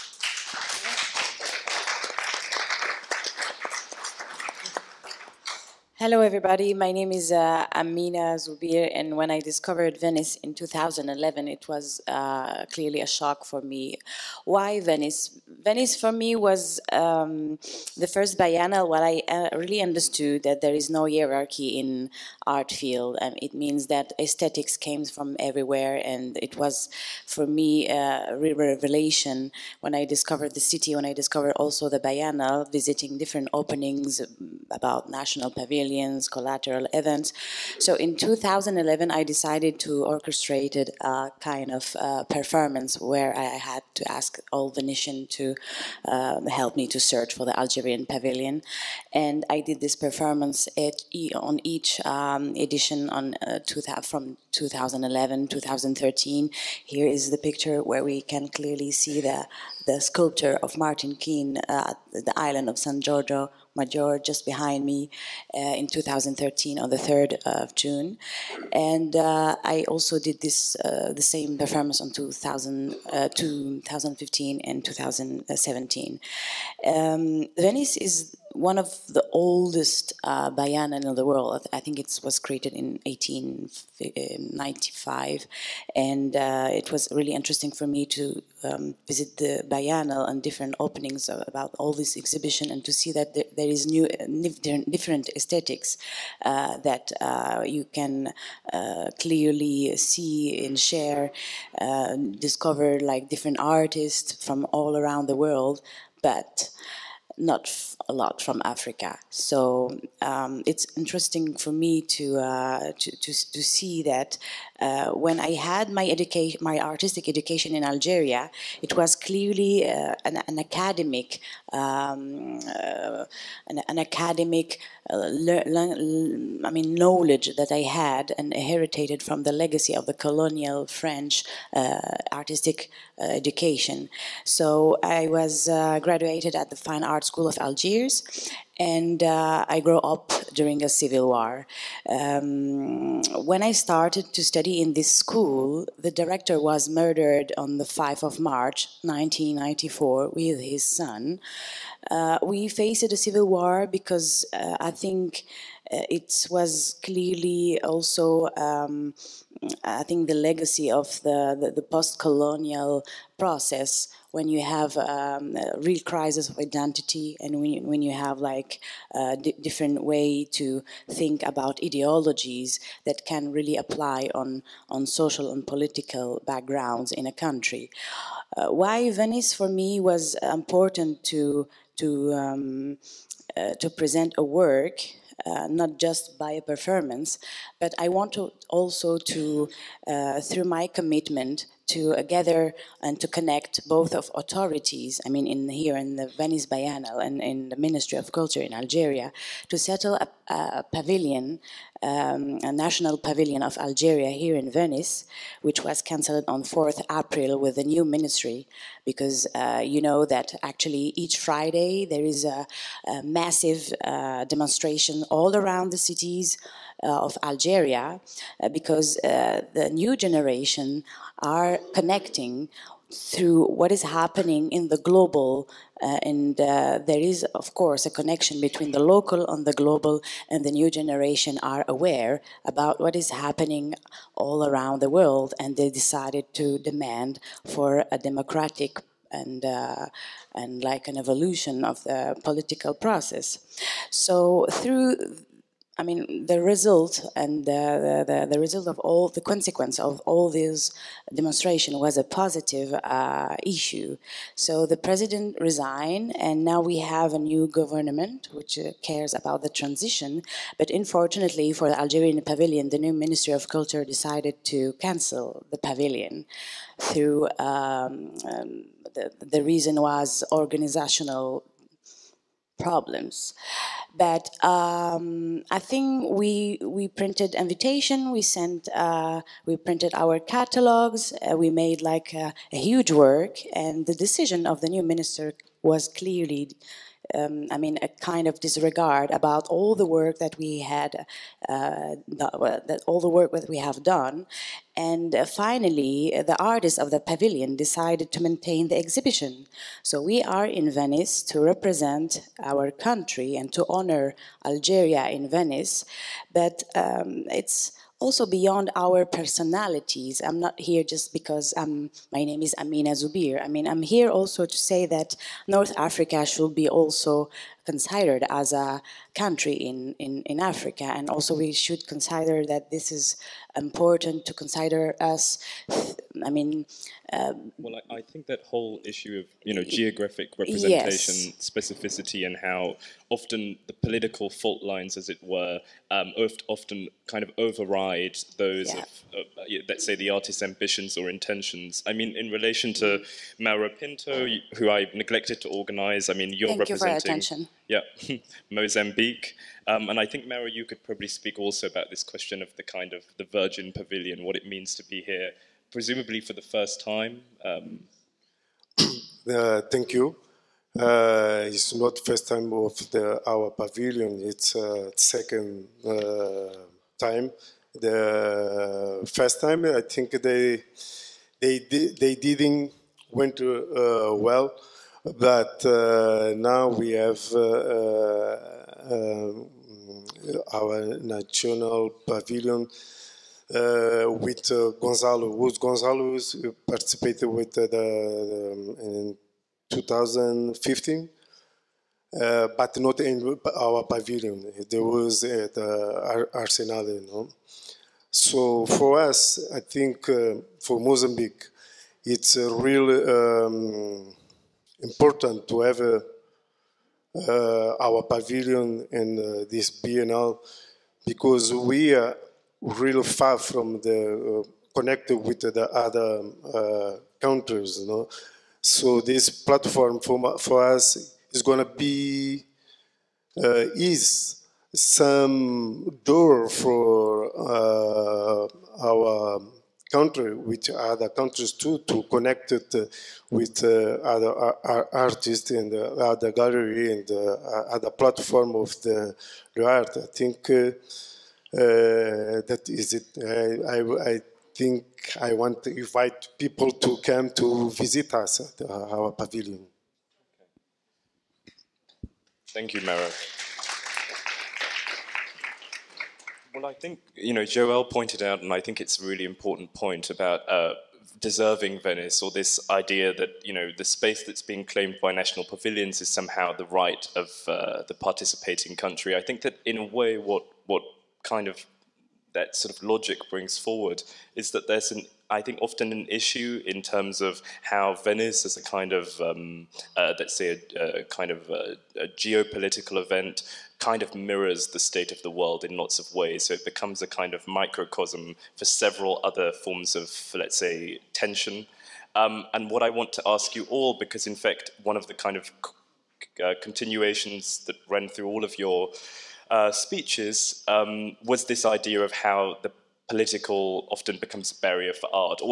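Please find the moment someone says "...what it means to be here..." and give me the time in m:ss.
5:54.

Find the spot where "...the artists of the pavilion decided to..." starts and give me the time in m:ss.
4:56.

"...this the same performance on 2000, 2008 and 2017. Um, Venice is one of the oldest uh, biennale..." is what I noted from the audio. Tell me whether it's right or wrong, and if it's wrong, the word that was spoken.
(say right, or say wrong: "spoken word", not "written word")
wrong: "2015", not "2008".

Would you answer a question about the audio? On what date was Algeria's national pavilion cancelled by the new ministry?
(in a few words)
4 April.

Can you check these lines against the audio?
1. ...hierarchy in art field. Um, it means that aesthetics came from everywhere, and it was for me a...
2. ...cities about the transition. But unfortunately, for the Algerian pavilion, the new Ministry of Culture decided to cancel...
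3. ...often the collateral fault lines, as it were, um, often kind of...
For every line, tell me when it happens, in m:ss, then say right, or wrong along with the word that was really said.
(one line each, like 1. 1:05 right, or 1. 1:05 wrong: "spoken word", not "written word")
1. 0:21 right
2. 4:19 wrong: "cares", not "cities"
3. 5:33 wrong: "political", not "collateral".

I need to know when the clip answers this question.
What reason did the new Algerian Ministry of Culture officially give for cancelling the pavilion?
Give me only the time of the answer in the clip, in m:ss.
4:30.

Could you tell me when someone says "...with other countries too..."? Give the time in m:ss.
7:10.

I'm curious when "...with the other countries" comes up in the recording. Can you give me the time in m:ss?
6:55.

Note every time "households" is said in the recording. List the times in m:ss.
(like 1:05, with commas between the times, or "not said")
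not said.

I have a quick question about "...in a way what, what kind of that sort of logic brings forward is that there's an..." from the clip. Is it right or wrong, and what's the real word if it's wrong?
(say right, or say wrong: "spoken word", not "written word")
right.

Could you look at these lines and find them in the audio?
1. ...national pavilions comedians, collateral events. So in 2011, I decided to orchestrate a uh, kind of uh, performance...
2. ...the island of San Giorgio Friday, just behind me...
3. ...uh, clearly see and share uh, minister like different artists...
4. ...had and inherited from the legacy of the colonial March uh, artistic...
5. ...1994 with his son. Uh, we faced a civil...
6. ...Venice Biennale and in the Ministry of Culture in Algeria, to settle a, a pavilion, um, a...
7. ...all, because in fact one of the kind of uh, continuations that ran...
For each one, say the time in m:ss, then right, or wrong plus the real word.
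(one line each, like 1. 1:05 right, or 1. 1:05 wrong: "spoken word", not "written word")
1. 0:35 right
2. 1:02 wrong: "Maggiore", not "Friday"
3. 1:38 wrong: "discover", not "minister"
4. 2:07 wrong: "French", not "March"
5. 2:29 right
6. 3:16 right
7. 8:13 right.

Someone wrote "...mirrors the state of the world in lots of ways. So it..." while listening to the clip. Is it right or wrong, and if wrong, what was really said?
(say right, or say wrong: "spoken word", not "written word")
right.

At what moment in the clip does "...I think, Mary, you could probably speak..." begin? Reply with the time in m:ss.
5:50.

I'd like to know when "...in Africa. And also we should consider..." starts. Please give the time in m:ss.
5:20.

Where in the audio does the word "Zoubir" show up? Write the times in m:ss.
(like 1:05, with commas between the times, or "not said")
0:08, 5:13.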